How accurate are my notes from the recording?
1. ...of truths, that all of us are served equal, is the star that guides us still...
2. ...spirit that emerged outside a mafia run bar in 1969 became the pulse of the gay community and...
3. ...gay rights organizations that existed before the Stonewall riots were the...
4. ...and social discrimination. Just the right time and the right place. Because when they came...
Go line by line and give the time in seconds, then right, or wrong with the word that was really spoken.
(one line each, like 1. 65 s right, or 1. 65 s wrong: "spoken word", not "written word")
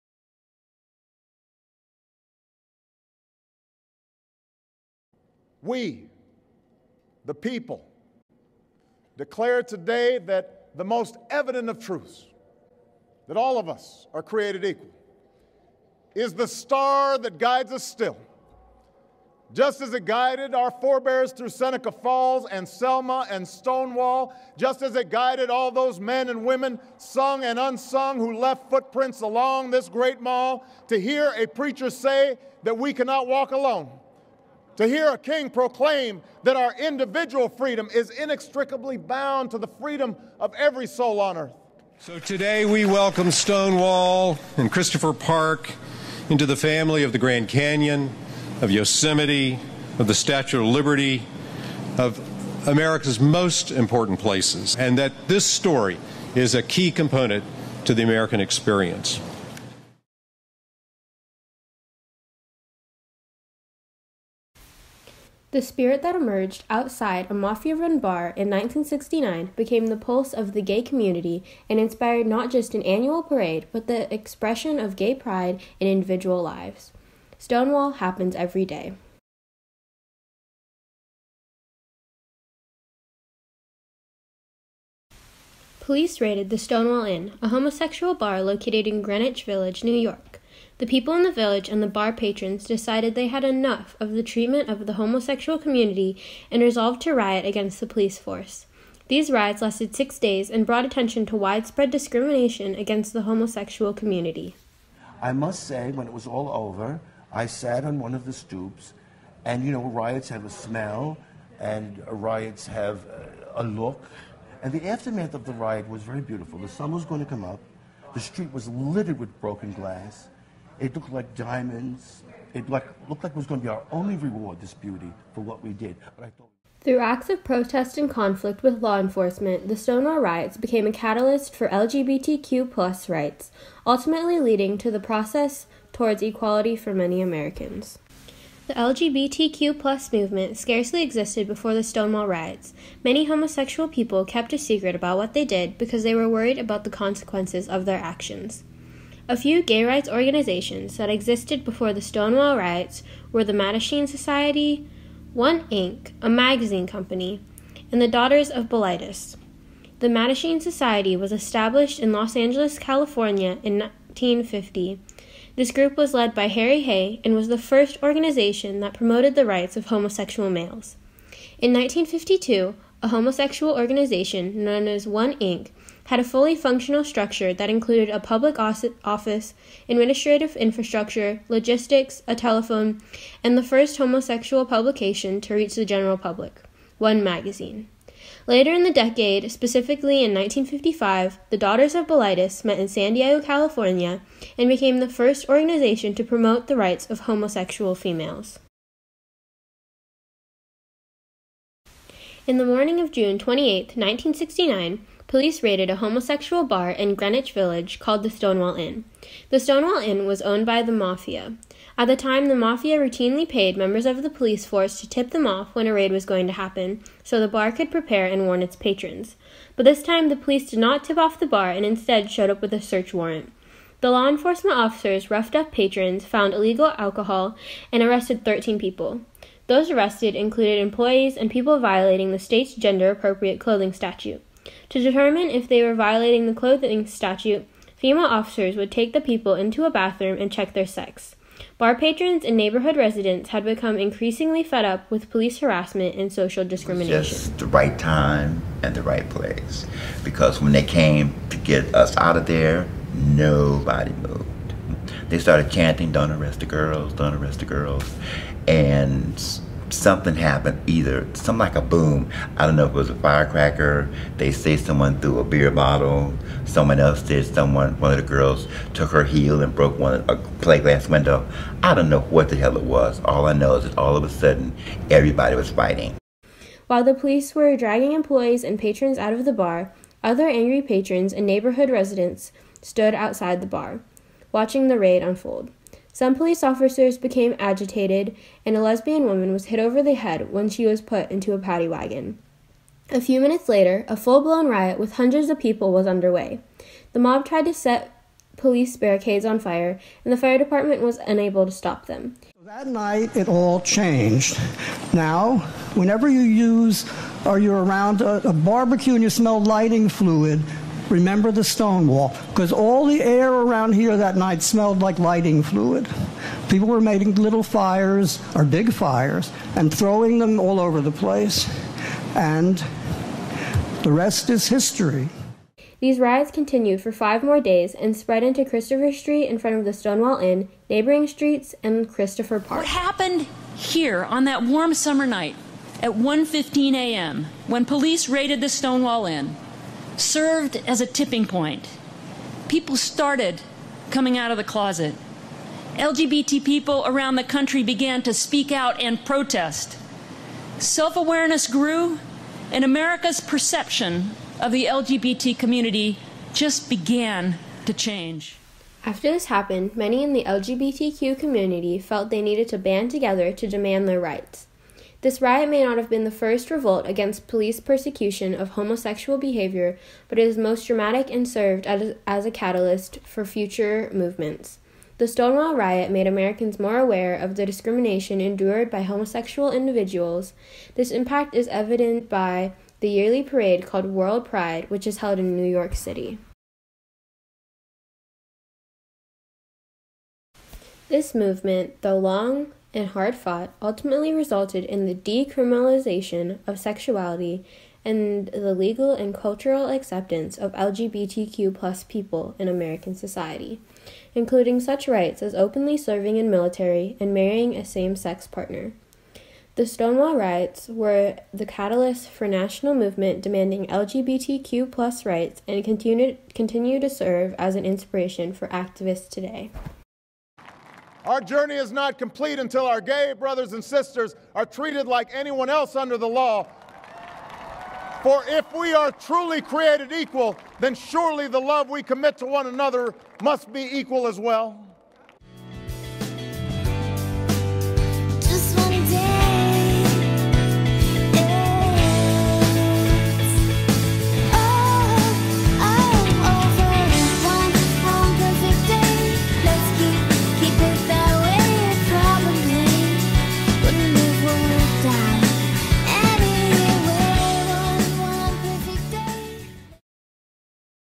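1. 11 s wrong: "created", not "served"
2. 65 s right
3. 149 s right
4. 246 s right.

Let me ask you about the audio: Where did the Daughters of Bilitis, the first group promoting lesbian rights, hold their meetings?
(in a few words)
San Diego.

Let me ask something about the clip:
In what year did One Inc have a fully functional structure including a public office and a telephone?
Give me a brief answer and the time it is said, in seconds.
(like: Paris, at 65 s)
1952, at 171 s.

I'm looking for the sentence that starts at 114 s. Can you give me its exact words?
And the aftermath of the riot was very beautiful.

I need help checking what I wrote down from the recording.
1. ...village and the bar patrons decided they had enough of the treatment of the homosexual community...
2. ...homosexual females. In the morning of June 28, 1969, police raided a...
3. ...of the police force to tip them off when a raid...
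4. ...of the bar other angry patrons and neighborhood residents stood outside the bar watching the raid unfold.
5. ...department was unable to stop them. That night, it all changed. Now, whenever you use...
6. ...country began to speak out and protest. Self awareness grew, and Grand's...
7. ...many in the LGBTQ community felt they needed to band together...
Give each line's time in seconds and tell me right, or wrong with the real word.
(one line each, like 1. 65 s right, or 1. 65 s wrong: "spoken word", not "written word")
1. 91 s right
2. 197 s right
3. 214 s right
4. 279 s right
5. 300 s right
6. 347 s wrong: "America", not "Grand"
7. 359 s right.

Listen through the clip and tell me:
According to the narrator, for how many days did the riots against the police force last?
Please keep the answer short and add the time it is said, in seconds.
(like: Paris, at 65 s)
6, at 99 s.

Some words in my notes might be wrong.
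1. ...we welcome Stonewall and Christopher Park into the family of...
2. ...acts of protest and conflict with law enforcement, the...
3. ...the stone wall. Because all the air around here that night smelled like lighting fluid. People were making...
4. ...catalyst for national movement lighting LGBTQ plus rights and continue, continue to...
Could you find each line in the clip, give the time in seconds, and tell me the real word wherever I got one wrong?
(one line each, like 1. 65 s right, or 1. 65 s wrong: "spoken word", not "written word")
1. 42 s right
2. 126 s right
3. 311 s right
4. 411 s wrong: "demanding", not "lighting".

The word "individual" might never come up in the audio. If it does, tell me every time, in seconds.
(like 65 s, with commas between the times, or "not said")
36 s, 75 s, 379 s.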